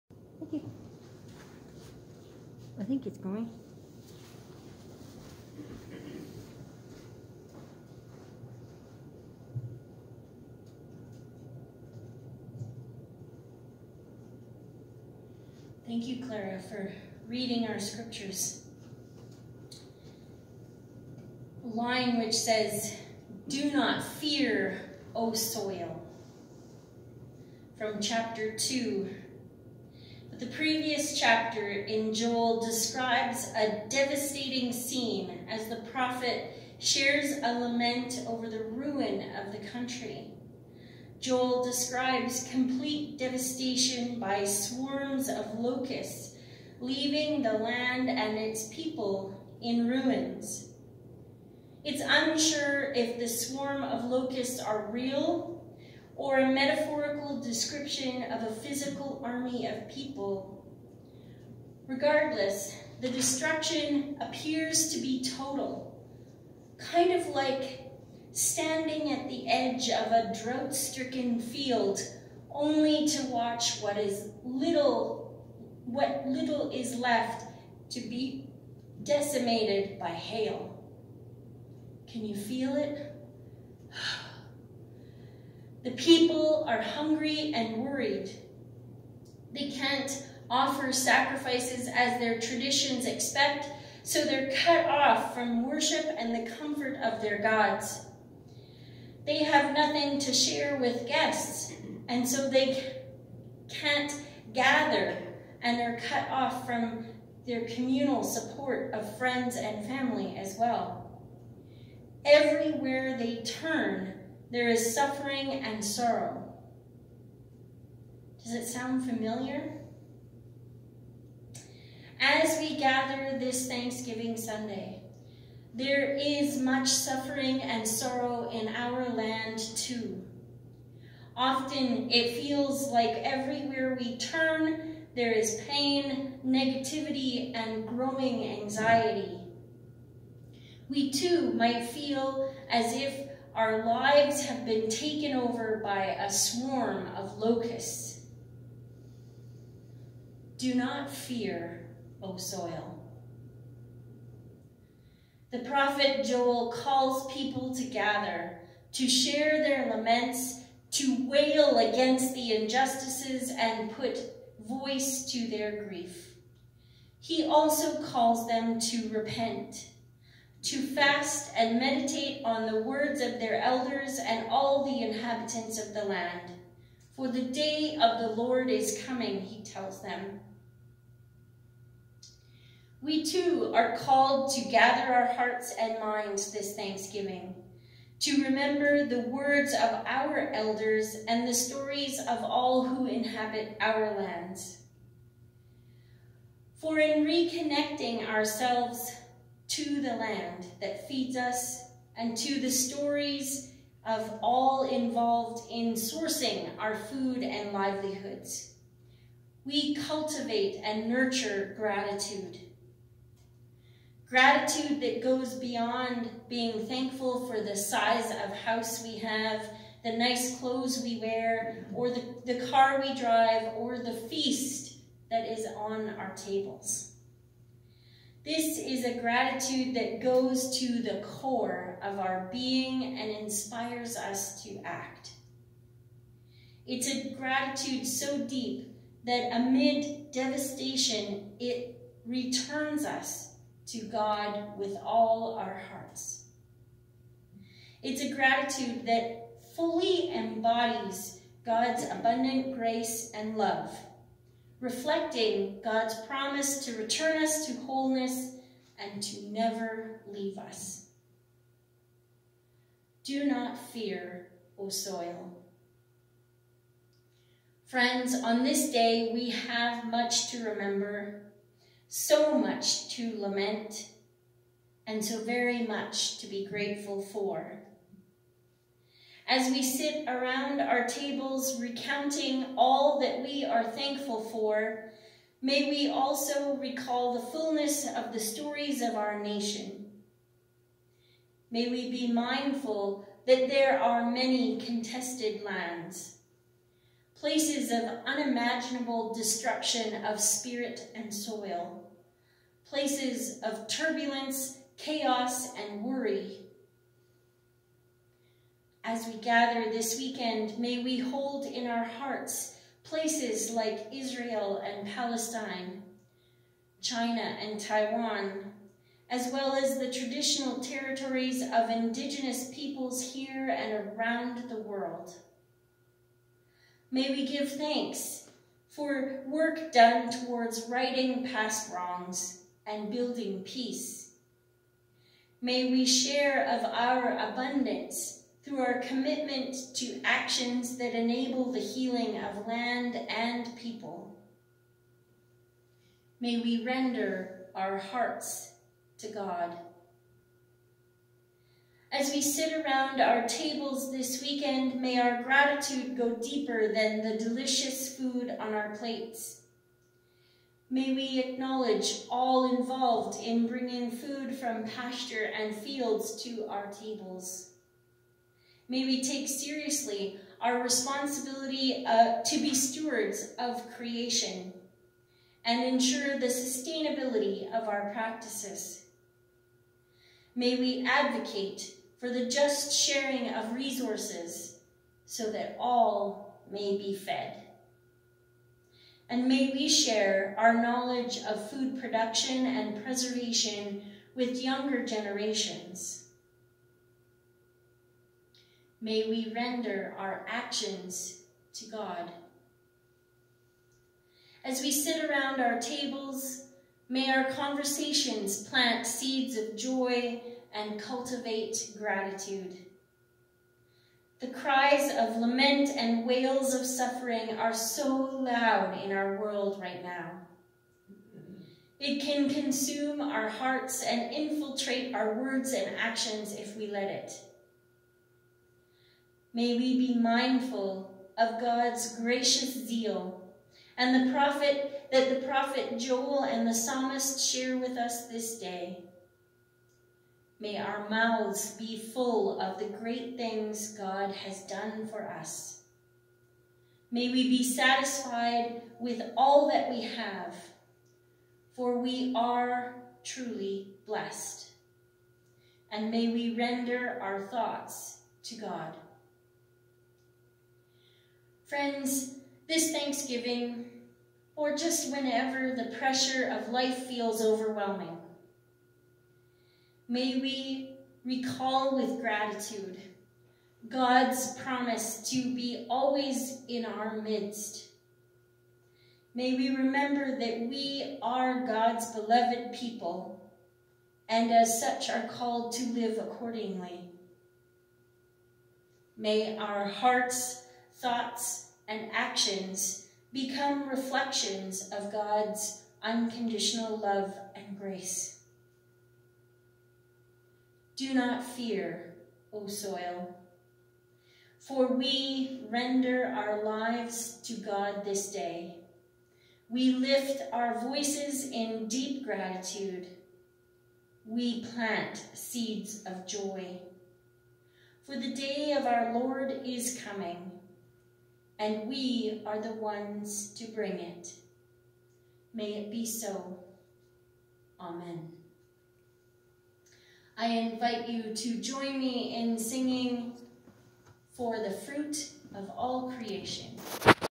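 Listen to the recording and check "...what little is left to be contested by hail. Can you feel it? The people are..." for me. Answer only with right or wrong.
wrong.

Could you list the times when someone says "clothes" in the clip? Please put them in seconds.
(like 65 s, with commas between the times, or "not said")
220 s.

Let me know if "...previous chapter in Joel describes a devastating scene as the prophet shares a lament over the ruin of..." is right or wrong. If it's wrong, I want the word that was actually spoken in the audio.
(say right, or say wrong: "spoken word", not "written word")
right.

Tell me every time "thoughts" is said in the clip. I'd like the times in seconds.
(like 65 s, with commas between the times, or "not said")
457 s, 491 s.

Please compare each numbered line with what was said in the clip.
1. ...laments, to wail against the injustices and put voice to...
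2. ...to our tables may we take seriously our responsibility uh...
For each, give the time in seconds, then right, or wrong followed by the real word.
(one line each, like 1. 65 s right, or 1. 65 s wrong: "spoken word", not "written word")
1. 159 s right
2. 366 s right.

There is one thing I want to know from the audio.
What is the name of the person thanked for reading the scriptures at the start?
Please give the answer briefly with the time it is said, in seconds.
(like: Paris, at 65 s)
Clara, at 16 s.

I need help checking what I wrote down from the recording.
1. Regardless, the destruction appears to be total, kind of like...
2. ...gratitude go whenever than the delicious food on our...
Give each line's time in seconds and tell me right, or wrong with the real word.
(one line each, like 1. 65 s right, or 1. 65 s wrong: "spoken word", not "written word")
1. 61 s right
2. 355 s wrong: "deeper", not "whenever".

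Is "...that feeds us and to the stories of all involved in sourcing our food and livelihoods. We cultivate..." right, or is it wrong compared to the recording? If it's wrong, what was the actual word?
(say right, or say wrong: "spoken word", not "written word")
right.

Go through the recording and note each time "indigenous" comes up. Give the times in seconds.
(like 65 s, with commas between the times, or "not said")
321 s.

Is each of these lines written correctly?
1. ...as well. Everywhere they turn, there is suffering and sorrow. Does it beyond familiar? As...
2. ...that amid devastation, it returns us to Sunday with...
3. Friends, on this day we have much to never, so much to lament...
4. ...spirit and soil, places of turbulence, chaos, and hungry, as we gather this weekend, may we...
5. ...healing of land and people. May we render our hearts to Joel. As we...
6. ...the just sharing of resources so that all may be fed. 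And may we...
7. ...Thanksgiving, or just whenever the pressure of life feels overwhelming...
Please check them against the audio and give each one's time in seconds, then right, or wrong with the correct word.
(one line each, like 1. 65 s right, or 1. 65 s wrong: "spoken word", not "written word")
1. 110 s wrong: "sound", not "beyond"
2. 239 s wrong: "God", not "Sunday"
3. 267 s wrong: "remember", not "never"
4. 300 s wrong: "worry", not "hungry"
5. 341 s wrong: "God", not "Joel"
6. 382 s right
7. 462 s right.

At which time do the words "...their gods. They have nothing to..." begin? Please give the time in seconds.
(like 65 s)
97 s.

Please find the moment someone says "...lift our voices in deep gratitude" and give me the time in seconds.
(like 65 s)
509 s.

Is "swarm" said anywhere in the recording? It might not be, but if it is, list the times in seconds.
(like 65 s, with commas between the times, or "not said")
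44 s, 53 s, 146 s.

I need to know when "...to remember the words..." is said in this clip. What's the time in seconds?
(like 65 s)
188 s.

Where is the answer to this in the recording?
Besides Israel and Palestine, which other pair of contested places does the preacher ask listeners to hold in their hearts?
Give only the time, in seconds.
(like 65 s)
317 s.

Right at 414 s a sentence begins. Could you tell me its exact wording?
The cries of lament and wails of suffering are so loud in our world right now.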